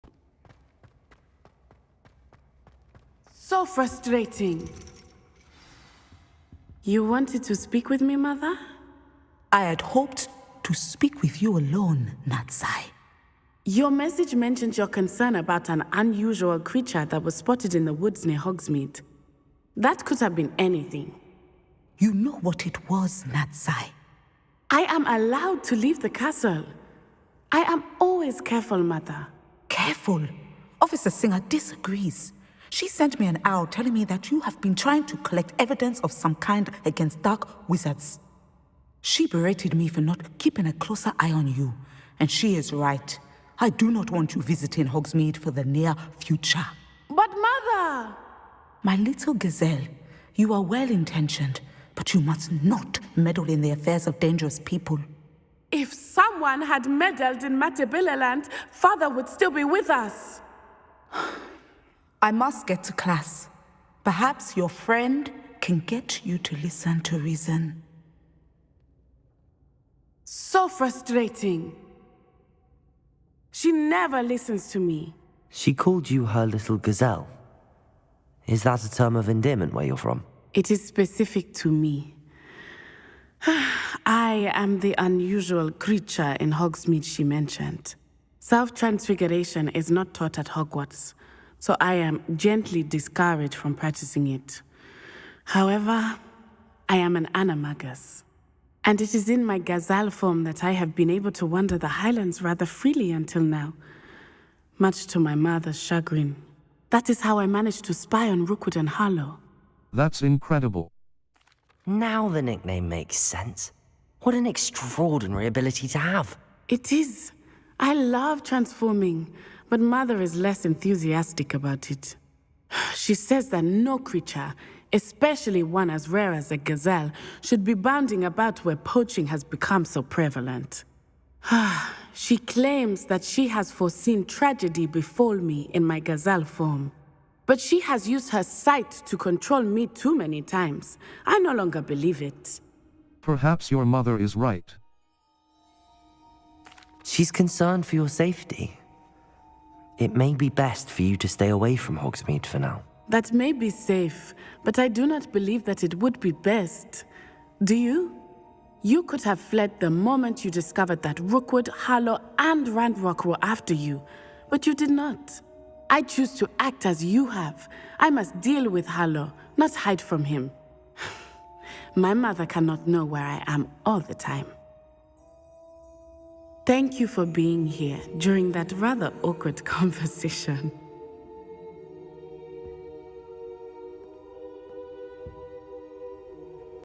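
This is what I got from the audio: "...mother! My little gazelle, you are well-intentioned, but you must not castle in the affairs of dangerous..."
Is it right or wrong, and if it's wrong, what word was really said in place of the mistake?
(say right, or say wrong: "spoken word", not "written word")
wrong: "meddle", not "castle".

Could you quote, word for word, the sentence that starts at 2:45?
I choose to act as you have.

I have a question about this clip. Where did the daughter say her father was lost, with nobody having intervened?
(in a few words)
Matabeleland.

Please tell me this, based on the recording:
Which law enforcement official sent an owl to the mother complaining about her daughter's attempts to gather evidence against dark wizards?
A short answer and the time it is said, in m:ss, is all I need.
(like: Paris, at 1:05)
Officer Singer, at 0:30.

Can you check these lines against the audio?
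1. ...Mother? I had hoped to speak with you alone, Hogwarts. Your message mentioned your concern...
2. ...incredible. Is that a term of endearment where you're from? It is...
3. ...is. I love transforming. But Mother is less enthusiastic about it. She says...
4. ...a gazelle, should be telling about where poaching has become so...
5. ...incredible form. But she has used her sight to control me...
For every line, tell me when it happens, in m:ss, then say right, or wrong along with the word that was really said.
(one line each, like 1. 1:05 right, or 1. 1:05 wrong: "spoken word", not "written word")
1. 0:08 wrong: "Natsai", not "Hogwarts"
2. 1:16 wrong: "gazelle", not "incredible"
3. 1:56 right
4. 2:06 wrong: "bounding", not "telling"
5. 2:16 wrong: "gazelle", not "incredible".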